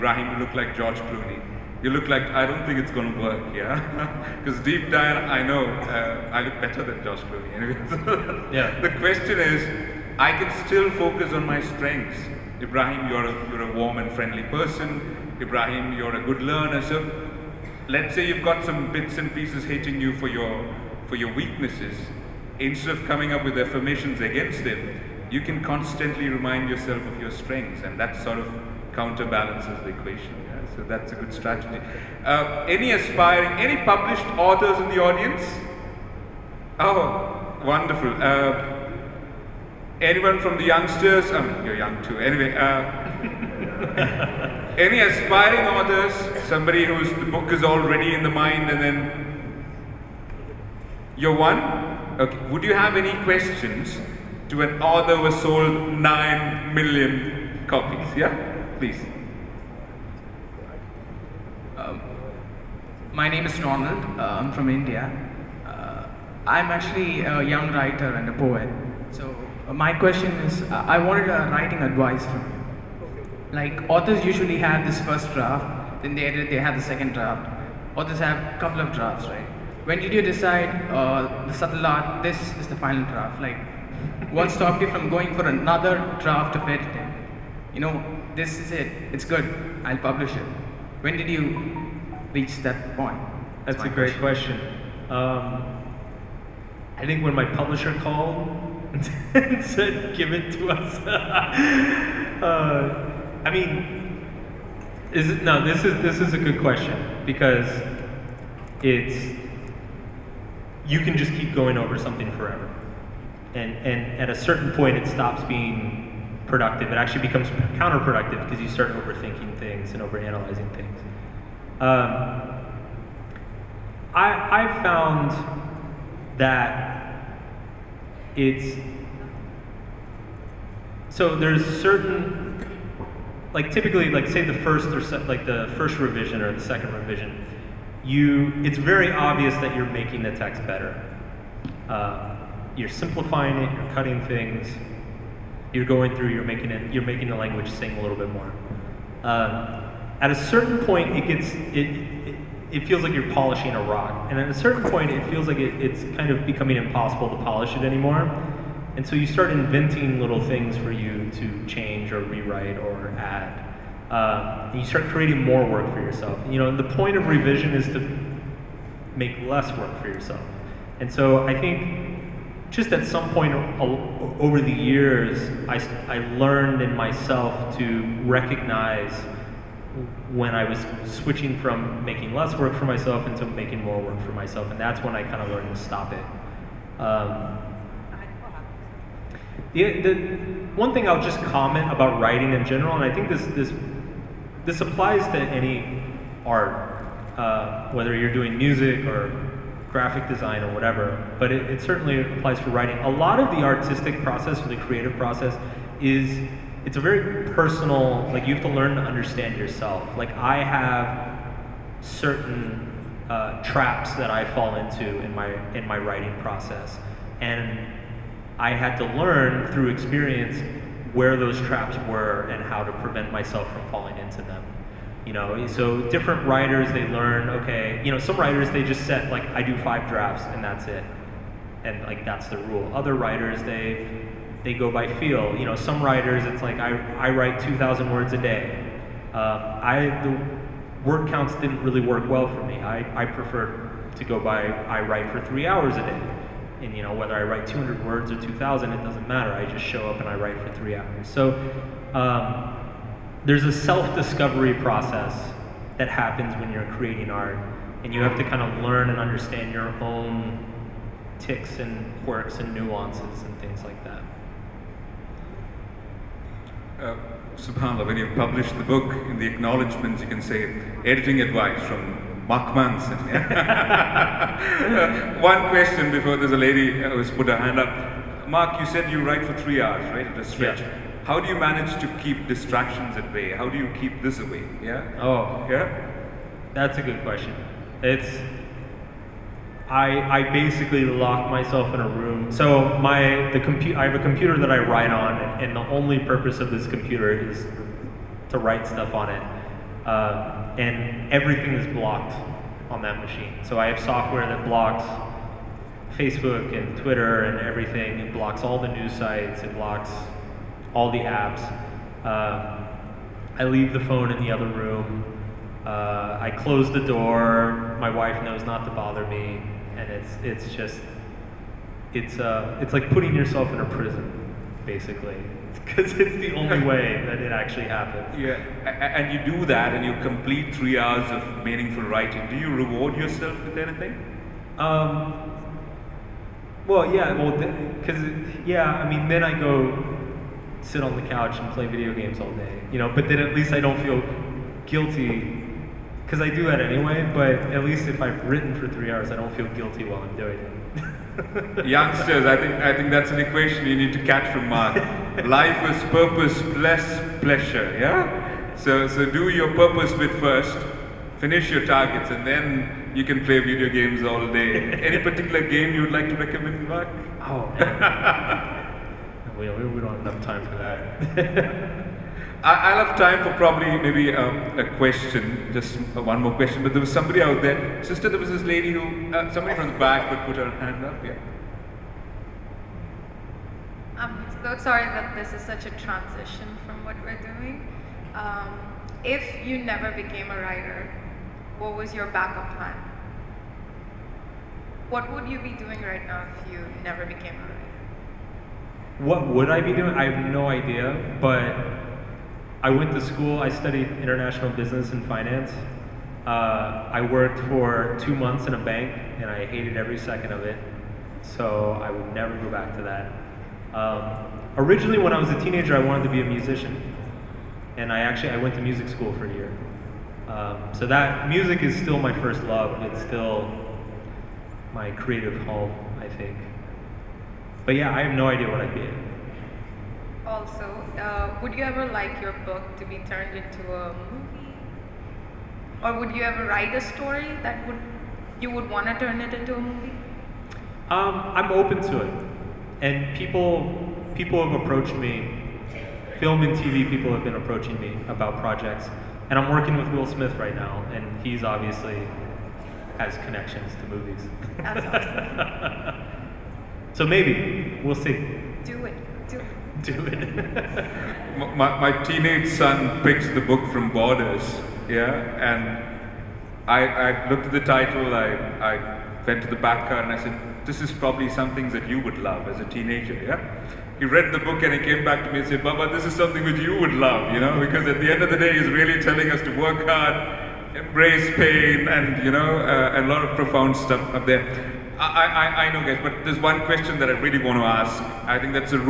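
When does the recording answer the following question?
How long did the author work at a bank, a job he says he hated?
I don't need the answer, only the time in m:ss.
6:48.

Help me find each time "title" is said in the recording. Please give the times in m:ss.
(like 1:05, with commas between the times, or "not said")
7:47.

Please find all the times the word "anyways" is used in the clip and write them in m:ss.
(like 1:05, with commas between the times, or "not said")
0:07, 0:42, 5:46.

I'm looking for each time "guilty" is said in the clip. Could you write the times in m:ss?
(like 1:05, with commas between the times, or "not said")
5:44, 5:49.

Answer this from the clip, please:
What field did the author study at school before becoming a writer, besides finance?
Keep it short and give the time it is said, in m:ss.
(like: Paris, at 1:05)
international business, at 6:44.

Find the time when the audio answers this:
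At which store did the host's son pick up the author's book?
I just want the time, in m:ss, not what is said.
7:44.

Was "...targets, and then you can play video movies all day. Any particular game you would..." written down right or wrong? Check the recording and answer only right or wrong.
wrong.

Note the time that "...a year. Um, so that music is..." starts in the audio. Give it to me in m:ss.
6:59.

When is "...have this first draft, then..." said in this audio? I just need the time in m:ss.
1:14.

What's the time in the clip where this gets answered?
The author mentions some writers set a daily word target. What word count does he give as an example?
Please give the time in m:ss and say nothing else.
3:57.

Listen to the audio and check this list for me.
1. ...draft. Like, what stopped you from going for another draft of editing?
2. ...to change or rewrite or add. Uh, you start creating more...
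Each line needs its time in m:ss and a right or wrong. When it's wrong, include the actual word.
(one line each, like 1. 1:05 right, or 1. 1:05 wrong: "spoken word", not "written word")
1. 1:23 right
2. 2:41 right.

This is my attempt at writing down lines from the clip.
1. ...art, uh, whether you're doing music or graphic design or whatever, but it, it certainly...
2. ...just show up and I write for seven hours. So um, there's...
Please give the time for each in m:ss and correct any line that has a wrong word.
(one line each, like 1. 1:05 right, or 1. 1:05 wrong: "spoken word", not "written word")
1. 3:16 right
2. 4:09 wrong: "three", not "seven".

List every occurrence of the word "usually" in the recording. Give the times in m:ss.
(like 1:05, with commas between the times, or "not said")
1:14.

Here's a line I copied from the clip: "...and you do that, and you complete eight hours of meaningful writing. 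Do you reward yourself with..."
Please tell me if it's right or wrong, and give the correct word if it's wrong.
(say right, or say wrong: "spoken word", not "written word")
wrong: "three", not "eight".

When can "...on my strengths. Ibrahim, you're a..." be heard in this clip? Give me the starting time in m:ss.
0:11.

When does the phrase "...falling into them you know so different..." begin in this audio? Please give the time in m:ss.
3:43.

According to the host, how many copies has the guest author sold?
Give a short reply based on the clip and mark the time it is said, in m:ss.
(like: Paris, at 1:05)
9 million, at 0:55.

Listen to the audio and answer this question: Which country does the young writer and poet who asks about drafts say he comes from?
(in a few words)
India.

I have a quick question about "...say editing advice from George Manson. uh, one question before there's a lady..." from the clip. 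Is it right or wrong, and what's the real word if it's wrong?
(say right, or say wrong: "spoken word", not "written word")
wrong: "Mark", not "George".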